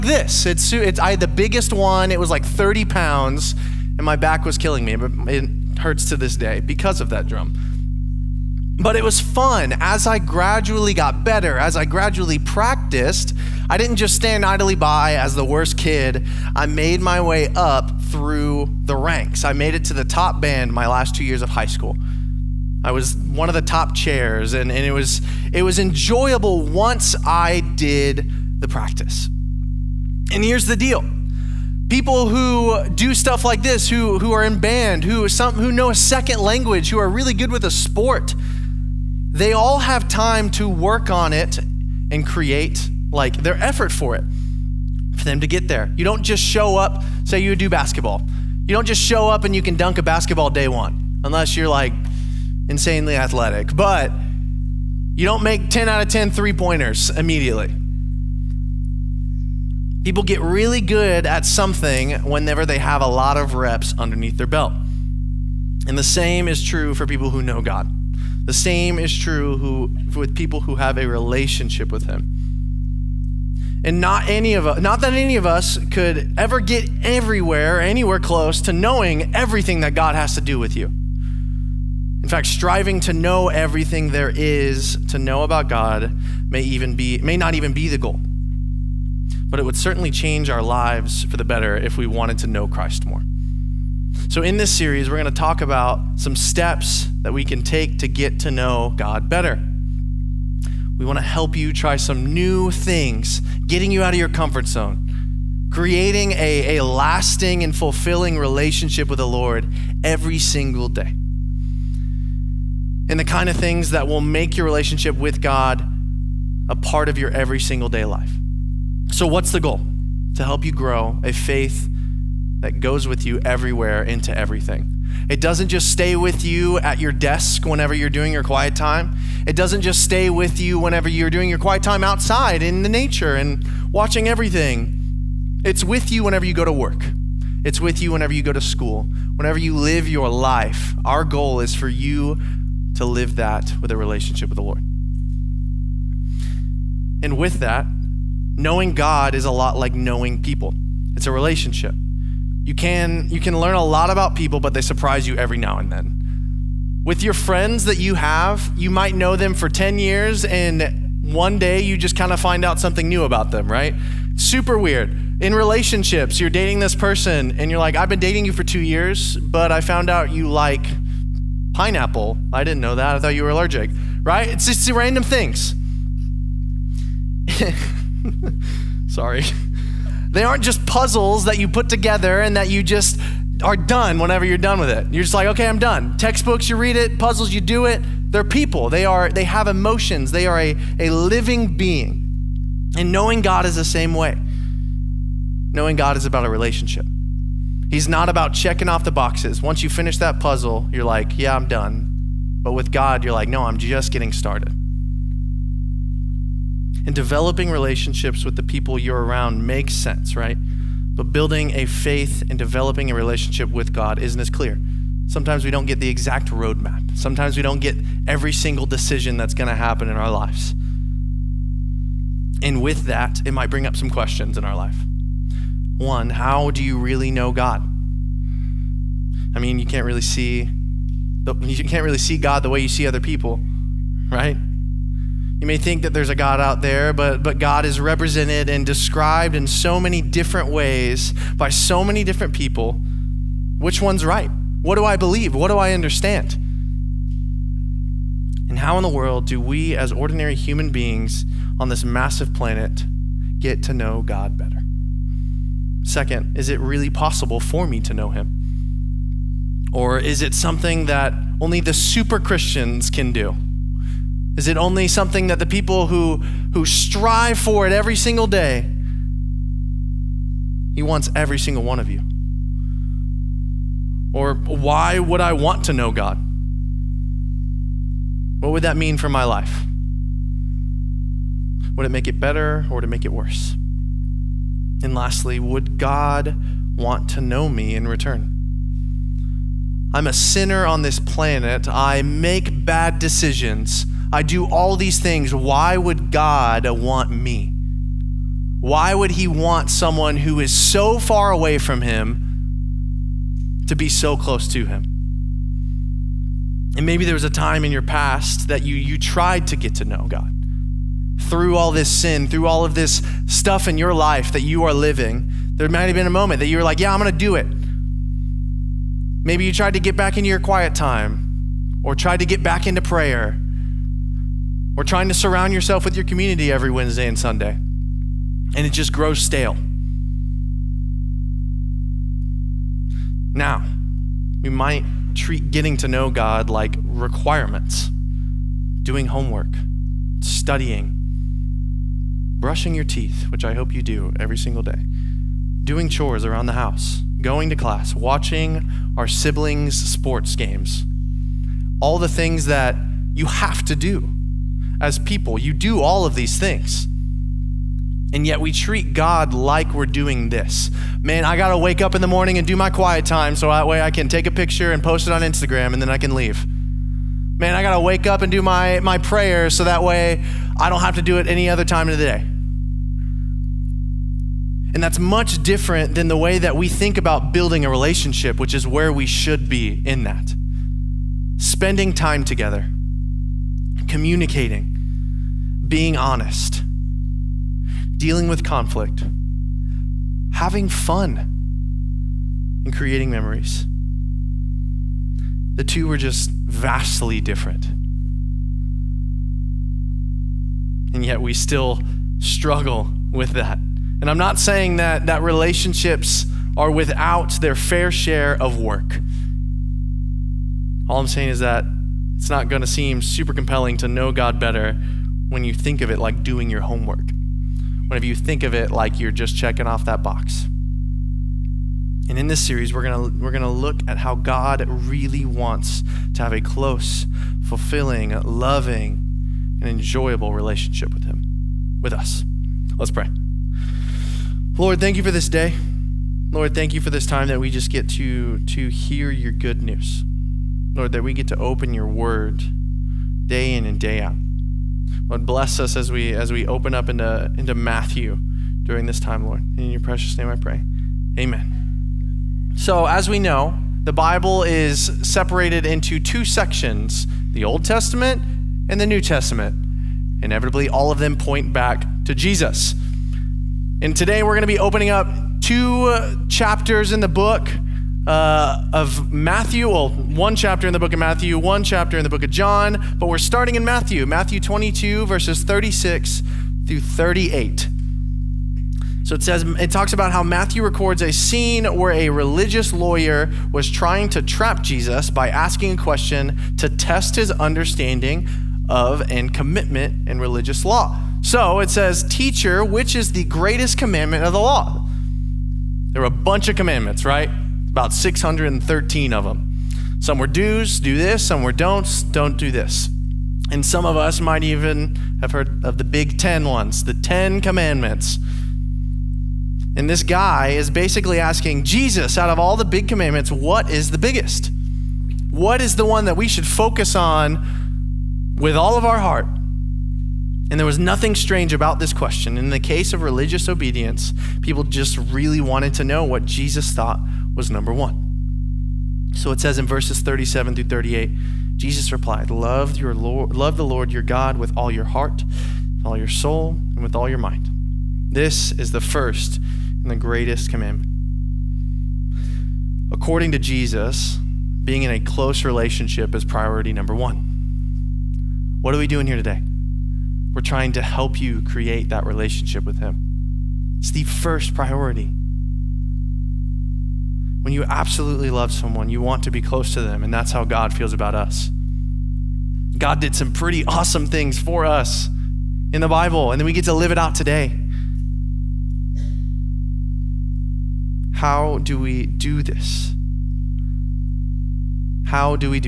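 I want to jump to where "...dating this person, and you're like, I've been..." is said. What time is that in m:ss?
2:46.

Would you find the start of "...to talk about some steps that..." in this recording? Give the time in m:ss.
1:35.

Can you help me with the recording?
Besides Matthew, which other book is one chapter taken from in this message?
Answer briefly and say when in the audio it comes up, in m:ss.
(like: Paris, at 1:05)
John, at 7:52.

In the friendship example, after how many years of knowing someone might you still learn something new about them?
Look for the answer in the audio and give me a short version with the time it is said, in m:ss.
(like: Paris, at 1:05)
10 years, at 2:39.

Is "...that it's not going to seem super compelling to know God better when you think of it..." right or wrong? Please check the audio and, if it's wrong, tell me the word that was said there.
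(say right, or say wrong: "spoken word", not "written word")
right.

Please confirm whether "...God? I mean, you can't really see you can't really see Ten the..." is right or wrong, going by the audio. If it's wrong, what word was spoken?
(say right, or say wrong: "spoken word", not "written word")
wrong: "God", not "Ten".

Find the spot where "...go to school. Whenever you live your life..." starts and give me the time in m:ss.
2:18.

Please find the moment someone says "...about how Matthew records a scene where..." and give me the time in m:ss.
8:00.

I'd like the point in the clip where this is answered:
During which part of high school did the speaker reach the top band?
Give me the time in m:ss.
0:20.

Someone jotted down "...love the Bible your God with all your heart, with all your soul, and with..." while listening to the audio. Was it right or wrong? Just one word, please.
wrong.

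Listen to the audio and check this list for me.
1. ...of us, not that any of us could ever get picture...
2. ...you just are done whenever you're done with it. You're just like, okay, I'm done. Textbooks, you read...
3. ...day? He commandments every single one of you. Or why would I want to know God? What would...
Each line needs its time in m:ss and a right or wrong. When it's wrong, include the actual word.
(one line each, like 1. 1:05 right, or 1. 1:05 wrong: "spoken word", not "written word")
1. 1:14 wrong: "everywhere", not "picture"
2. 3:02 right
3. 4:28 wrong: "wants", not "commandments".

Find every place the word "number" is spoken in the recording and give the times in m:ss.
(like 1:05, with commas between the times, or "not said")
8:47, 9:06.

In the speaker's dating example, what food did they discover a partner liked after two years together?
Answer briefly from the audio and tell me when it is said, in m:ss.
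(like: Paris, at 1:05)
pineapple, at 2:51.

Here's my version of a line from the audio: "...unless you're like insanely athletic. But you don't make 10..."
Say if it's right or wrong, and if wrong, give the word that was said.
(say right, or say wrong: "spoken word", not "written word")
right.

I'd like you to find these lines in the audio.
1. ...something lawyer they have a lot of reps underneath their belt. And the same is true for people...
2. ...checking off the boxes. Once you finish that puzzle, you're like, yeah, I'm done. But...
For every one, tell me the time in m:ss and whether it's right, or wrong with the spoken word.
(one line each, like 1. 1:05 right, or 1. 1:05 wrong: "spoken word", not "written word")
1. 1:01 wrong: "whenever", not "lawyer"
2. 3:18 right.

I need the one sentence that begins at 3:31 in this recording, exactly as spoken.
But building a faith and developing a relationship with God isn't as clear.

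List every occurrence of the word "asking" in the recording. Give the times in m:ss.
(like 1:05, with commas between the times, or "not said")
8:05, 8:31.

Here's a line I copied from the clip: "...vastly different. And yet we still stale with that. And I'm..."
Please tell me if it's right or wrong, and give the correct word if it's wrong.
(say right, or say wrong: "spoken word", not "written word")
wrong: "struggle", not "stale".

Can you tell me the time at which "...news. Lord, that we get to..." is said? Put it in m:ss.
7:19.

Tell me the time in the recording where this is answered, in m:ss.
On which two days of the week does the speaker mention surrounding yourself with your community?
5:26.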